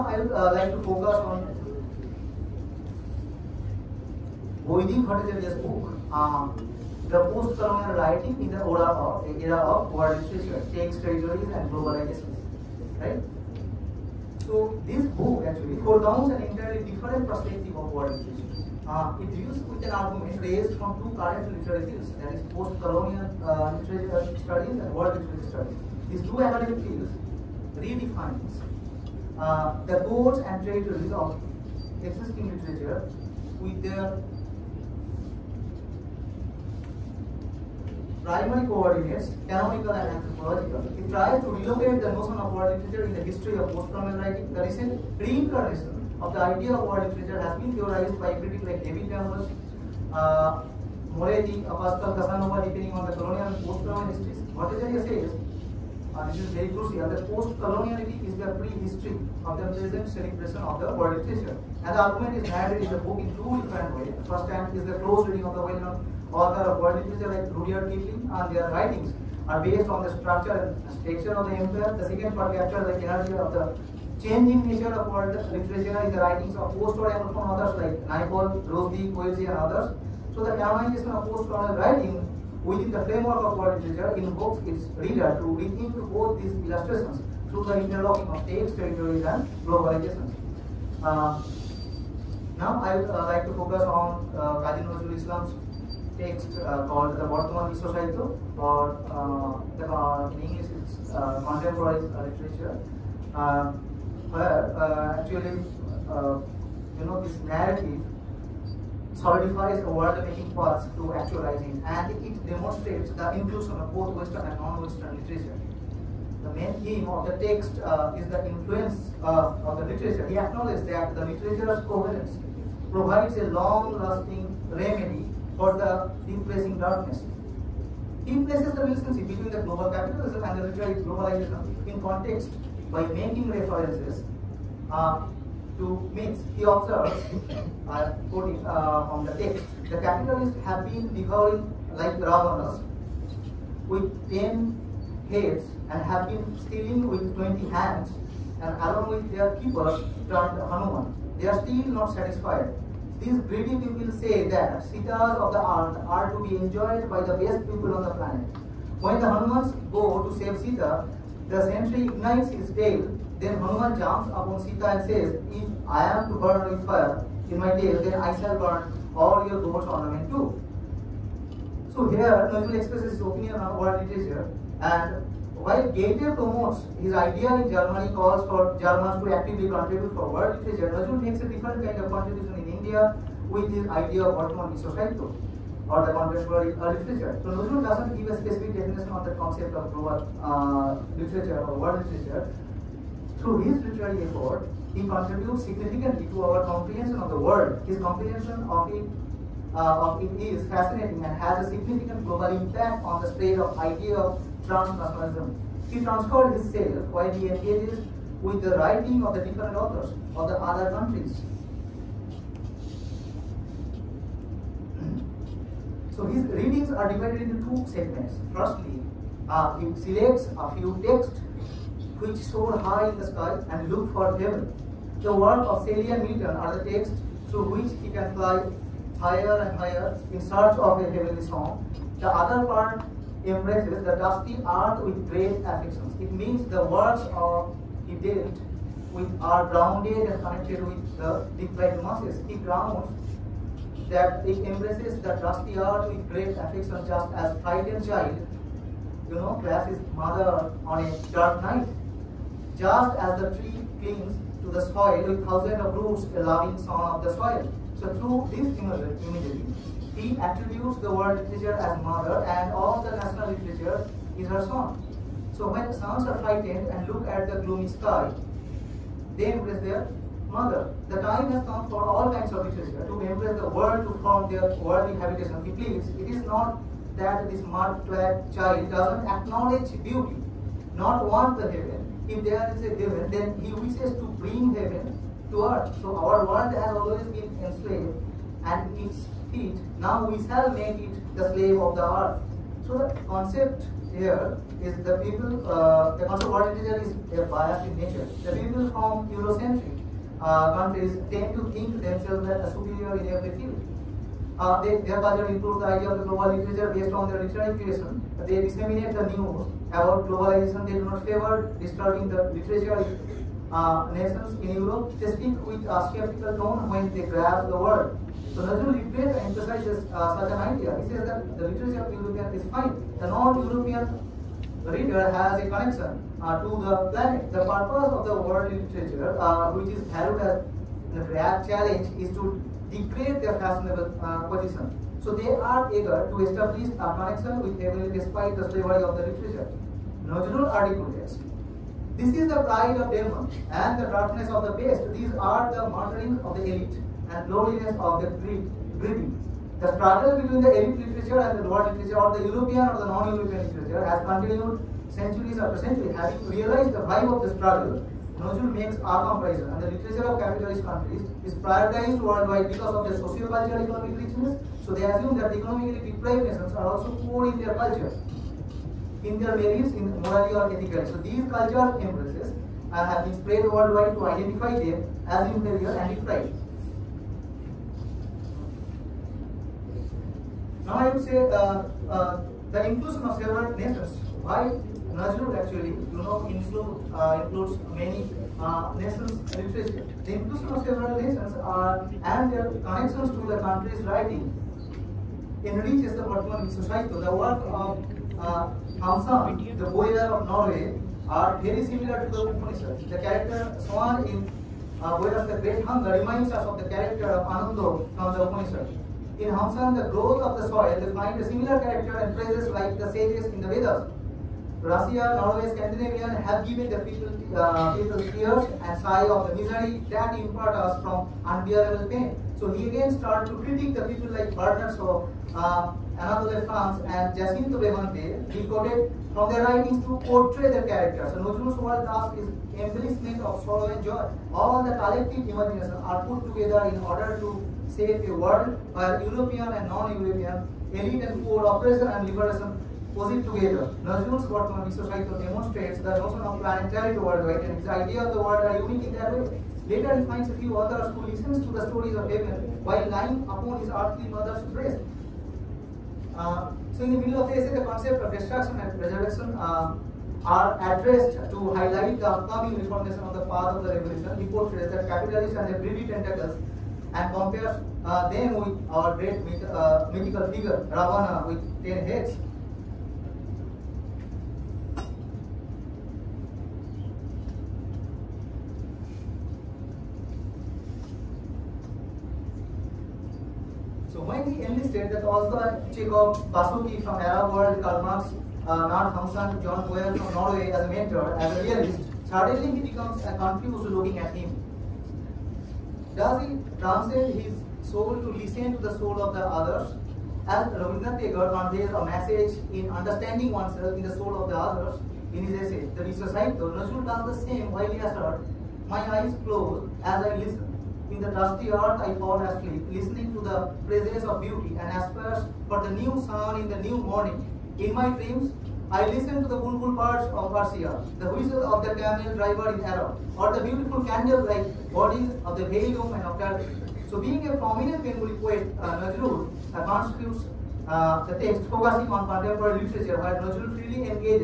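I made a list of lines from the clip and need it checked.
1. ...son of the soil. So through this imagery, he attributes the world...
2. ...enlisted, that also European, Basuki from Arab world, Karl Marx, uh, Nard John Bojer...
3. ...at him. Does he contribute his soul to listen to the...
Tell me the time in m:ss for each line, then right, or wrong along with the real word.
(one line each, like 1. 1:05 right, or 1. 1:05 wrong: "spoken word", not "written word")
1. 4:16 right
2. 8:04 wrong: "Chekhov", not "European"
3. 8:14 wrong: "translate", not "contribute".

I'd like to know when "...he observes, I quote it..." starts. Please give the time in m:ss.
2:16.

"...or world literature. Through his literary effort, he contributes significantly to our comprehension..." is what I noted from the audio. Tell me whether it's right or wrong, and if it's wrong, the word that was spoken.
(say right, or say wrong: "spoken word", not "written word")
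right.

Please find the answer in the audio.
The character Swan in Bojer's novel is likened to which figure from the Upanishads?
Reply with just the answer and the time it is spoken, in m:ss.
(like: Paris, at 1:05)
Anando, at 6:47.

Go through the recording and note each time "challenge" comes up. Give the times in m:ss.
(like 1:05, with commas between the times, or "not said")
5:31.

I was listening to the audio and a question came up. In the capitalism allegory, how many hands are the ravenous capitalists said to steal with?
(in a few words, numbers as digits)
20.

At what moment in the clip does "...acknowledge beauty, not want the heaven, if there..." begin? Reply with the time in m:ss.
4:39.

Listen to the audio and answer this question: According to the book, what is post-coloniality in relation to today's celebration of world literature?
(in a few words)
pre-history.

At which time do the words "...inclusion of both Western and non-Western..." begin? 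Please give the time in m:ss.
1:53.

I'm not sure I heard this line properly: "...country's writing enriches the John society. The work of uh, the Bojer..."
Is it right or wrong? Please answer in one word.
wrong.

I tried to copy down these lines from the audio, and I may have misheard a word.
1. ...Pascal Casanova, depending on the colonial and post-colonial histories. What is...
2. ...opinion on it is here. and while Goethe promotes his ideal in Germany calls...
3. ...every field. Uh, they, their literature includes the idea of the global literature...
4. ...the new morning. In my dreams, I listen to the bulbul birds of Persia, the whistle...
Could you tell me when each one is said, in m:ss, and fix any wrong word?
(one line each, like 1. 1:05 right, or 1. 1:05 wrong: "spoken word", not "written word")
1. 0:51 right
2. 2:53 right
3. 5:03 wrong: "culture", not "literature"
4. 8:36 right.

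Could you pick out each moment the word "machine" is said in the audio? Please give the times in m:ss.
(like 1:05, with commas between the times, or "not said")
not said.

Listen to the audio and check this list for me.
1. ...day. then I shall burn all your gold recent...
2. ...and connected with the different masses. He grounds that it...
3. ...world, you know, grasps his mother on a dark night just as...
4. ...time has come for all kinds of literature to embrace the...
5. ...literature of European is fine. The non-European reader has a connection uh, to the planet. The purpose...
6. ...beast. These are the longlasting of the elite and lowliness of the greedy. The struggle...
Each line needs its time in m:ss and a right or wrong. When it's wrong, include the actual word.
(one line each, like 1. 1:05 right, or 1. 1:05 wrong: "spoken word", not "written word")
1. 2:47 wrong: "ornament", not "recent"
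2. 4:00 right
3. 4:08 wrong: "child", not "world"
4. 4:31 right
5. 5:21 right
6. 5:44 wrong: "martyring", not "longlasting".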